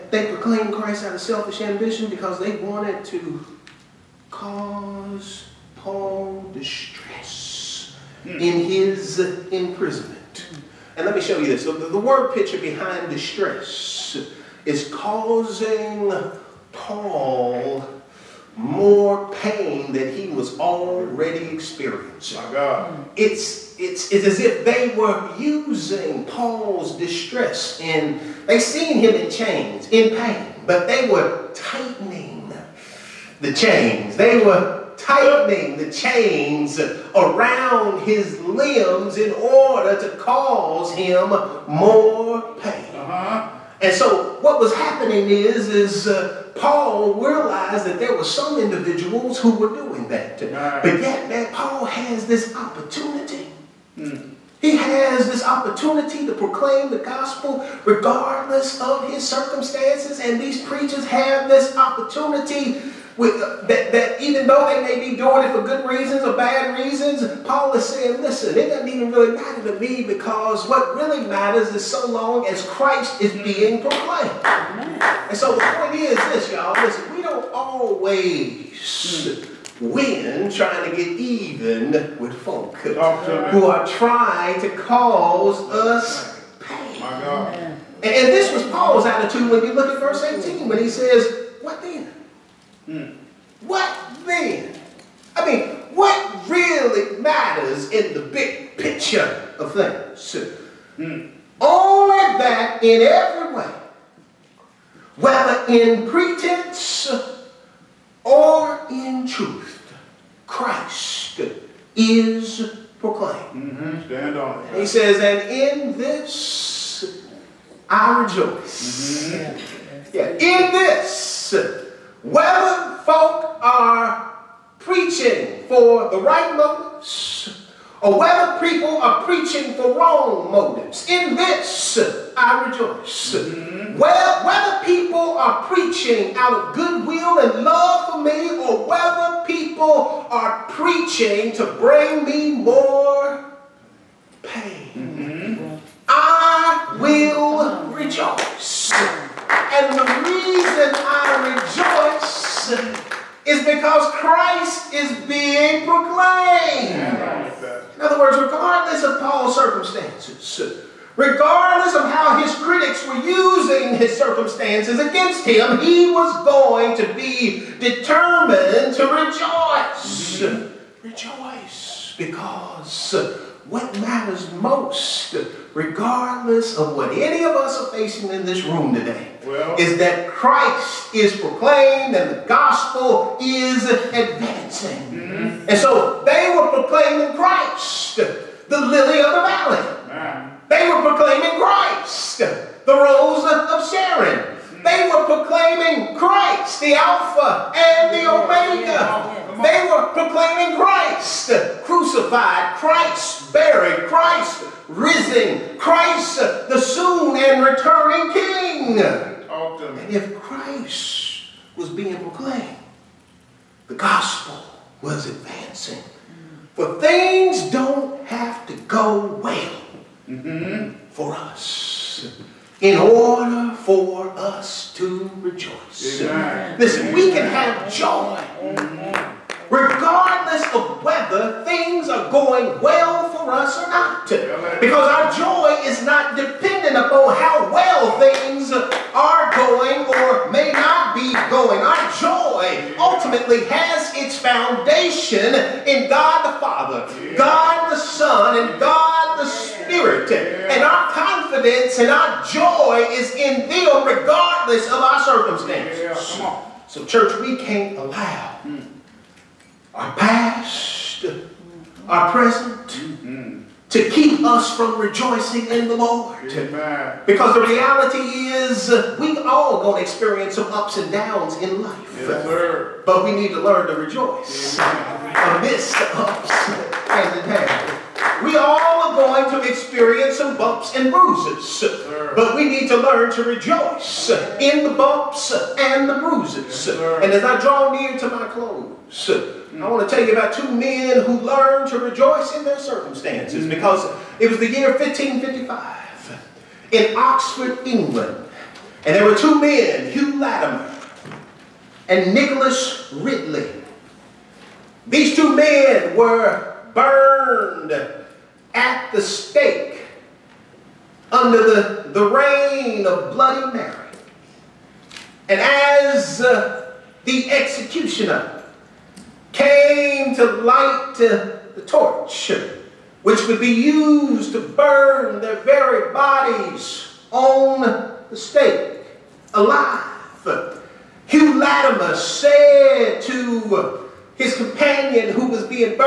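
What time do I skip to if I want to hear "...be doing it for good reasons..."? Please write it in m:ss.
1:05.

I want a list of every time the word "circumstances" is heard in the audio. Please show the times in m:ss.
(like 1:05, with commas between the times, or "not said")
0:59, 2:39, 2:44, 4:15, 4:52.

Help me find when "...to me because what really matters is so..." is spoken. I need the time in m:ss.
1:09.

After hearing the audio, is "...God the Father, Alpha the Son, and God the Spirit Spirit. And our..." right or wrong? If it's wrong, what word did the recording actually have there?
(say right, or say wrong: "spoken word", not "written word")
wrong: "God", not "Alpha".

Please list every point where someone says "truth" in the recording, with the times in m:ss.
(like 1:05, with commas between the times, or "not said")
1:49.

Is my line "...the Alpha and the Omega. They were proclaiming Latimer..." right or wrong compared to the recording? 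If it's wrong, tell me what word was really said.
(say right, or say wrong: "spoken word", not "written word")
wrong: "Christ", not "Latimer".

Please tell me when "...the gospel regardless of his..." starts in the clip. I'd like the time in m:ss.
0:56.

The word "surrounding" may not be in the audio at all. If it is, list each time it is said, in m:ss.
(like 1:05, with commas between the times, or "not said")
not said.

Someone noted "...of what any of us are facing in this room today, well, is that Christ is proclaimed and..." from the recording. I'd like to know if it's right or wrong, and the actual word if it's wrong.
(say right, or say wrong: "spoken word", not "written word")
right.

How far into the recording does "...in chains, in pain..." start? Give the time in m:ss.
0:29.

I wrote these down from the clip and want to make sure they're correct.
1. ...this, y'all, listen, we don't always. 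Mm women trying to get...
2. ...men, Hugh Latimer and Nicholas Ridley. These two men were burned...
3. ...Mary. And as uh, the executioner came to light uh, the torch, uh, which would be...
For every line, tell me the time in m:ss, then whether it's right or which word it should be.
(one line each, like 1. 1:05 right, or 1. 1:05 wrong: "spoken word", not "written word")
1. 1:16 right
2. 4:59 right
3. 5:13 right.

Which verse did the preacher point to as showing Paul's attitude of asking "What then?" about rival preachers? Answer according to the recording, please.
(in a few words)
Verse 18.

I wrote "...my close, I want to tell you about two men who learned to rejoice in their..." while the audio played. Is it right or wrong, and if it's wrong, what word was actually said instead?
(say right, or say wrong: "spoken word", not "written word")
right.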